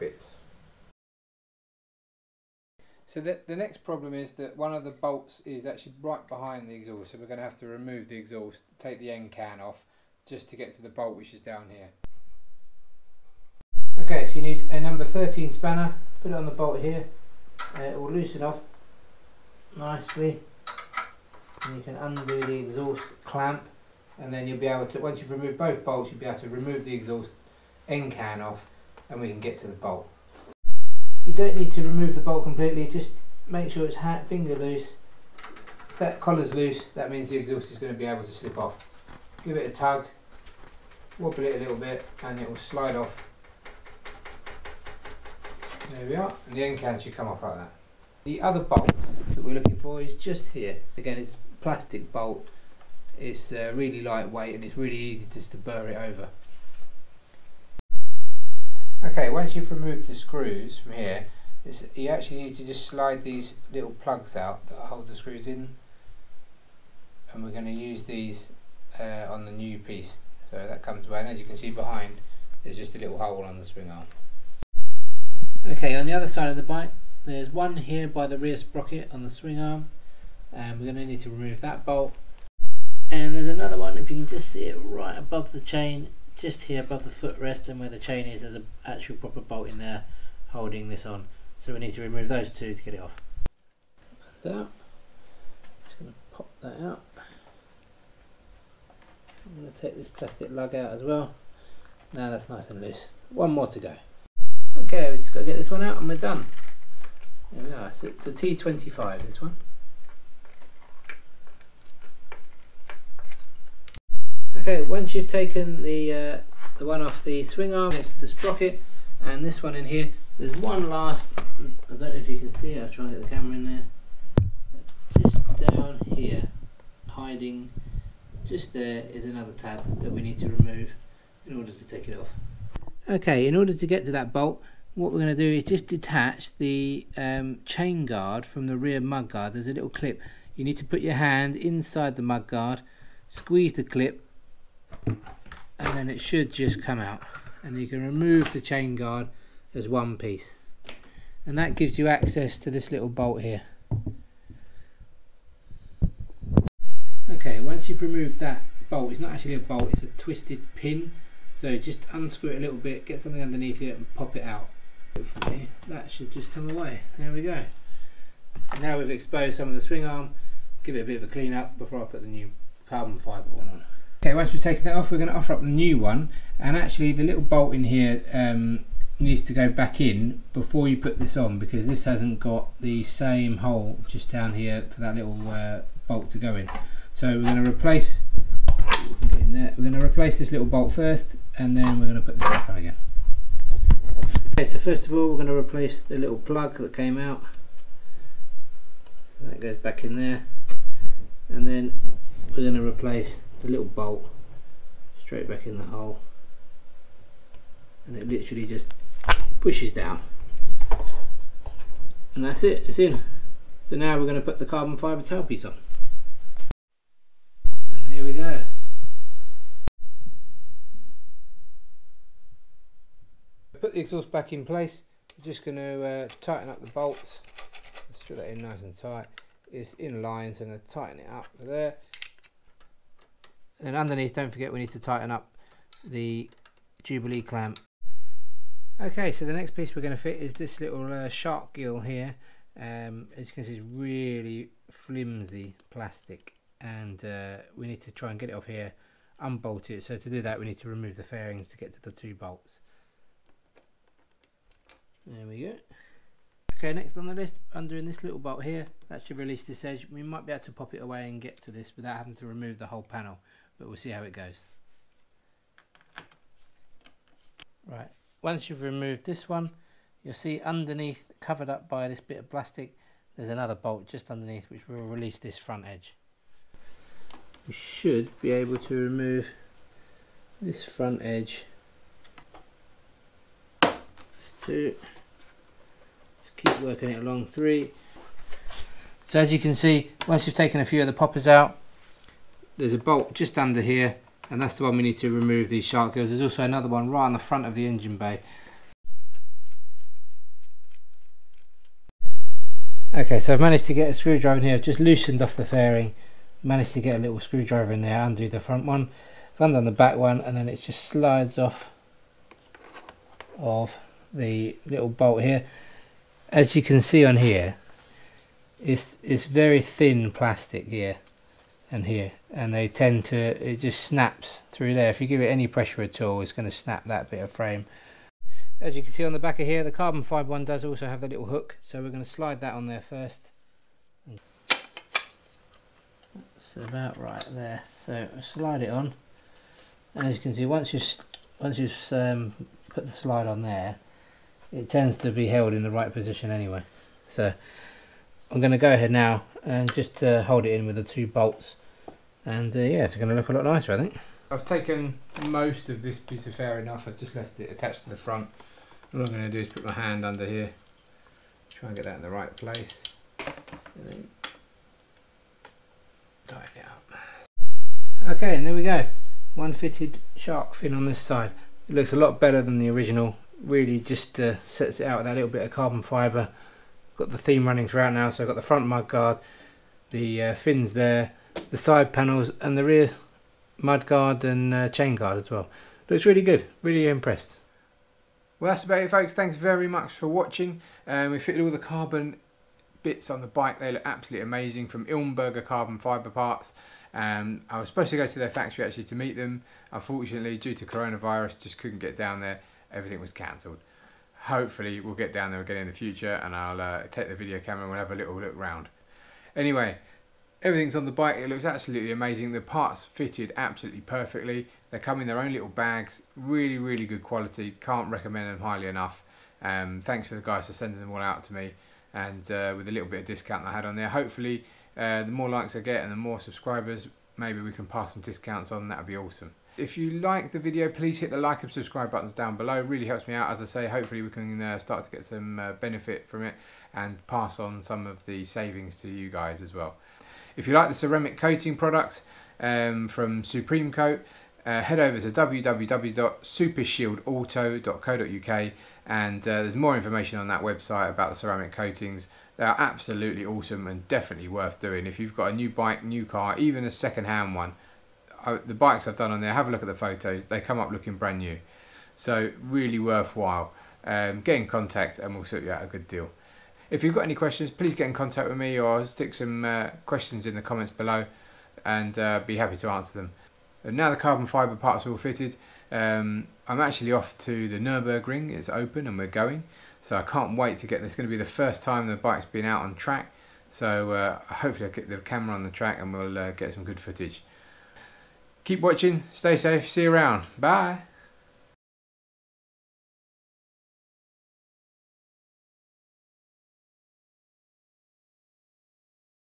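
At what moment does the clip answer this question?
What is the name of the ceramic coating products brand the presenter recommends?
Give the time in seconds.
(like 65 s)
443 s.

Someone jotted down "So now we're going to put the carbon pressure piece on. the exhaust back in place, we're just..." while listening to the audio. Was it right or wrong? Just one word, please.
wrong.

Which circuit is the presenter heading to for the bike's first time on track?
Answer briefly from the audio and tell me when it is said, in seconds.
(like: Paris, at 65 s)
Nürburgring, at 477 s.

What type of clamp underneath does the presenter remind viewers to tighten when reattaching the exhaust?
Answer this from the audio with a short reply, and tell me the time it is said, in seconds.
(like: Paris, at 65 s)
Jubilee clamp, at 237 s.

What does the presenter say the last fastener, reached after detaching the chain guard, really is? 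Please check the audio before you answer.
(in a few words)
twisted pin.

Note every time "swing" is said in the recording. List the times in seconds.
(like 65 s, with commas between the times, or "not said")
73 s, 79 s, 117 s, 169 s.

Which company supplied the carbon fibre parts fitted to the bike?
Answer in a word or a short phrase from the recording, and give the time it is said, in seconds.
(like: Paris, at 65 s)
Ilmberger, at 395 s.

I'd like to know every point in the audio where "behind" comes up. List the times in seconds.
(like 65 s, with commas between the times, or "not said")
6 s, 71 s.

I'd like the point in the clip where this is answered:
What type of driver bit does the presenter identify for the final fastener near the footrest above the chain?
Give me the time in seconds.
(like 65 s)
108 s.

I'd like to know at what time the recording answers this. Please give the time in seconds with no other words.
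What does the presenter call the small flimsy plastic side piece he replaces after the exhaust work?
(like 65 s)
241 s.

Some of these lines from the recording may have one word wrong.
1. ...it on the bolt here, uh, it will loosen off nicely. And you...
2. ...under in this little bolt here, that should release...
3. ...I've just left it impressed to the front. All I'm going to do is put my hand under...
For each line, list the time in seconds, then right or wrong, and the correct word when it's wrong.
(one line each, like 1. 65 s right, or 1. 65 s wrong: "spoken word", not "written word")
1. 16 s right
2. 257 s right
3. 357 s wrong: "attached", not "impressed".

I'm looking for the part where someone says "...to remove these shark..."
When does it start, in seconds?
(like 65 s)
295 s.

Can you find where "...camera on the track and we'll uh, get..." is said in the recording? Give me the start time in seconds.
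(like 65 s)
485 s.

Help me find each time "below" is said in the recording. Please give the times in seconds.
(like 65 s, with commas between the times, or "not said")
432 s, 470 s.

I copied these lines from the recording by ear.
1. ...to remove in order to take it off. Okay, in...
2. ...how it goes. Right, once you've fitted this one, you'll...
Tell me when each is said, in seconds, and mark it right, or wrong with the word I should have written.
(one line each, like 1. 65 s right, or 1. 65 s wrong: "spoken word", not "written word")
1. 130 s right
2. 264 s wrong: "removed", not "fitted".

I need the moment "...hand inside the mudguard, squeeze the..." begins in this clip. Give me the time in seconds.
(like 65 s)
141 s.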